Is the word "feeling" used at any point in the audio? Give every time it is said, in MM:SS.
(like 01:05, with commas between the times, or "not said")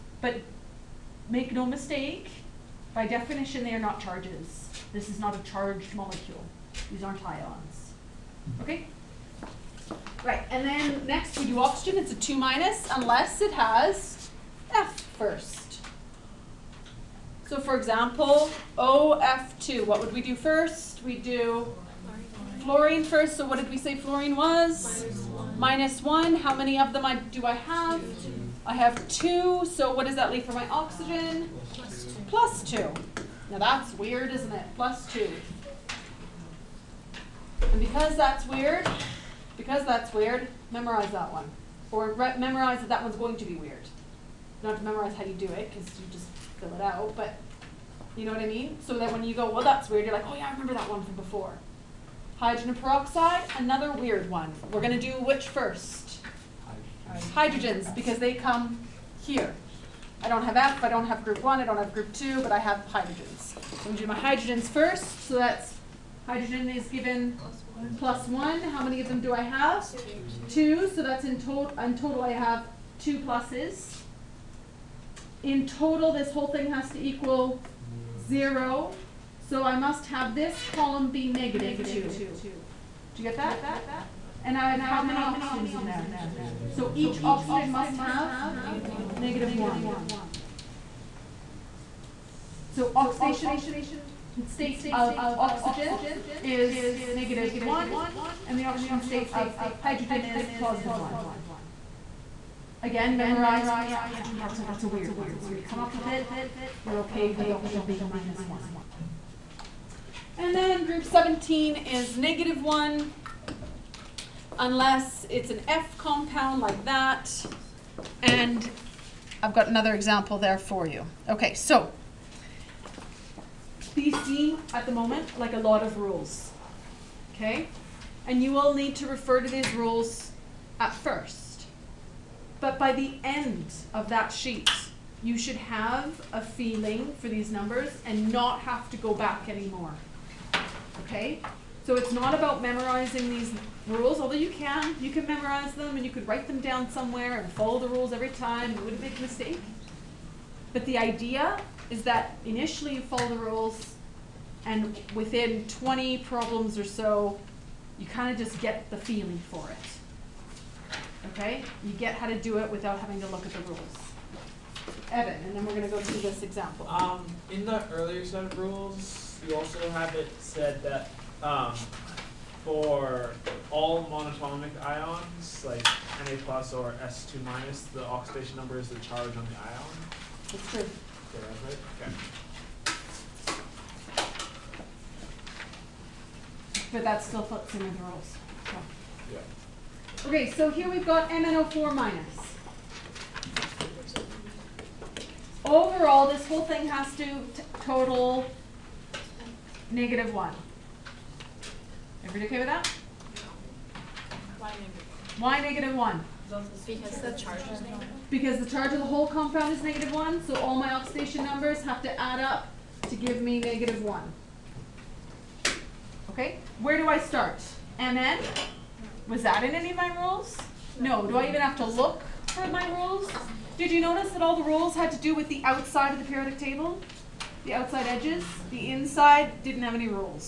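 02:16, 02:38.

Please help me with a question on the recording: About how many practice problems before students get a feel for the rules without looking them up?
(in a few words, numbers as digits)
20.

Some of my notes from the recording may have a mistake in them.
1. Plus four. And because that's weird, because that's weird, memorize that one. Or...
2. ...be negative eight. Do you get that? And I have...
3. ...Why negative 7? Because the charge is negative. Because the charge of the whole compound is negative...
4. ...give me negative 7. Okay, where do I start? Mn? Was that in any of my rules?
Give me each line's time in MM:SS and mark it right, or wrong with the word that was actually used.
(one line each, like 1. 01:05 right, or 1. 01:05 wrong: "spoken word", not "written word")
1. 00:34 wrong: "two", not "four"
2. 01:21 wrong: "two", not "eight"
3. 03:25 wrong: "1", not "7"
4. 03:33 wrong: "1", not "7".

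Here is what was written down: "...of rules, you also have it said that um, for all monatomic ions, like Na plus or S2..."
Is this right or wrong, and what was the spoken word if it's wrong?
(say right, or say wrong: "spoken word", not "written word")
right.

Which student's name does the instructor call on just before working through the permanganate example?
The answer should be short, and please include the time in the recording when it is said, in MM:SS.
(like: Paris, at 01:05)
Evan, at 02:45.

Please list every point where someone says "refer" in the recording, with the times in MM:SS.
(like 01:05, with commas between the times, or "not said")
02:09.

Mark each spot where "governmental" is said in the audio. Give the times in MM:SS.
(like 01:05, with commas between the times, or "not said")
not said.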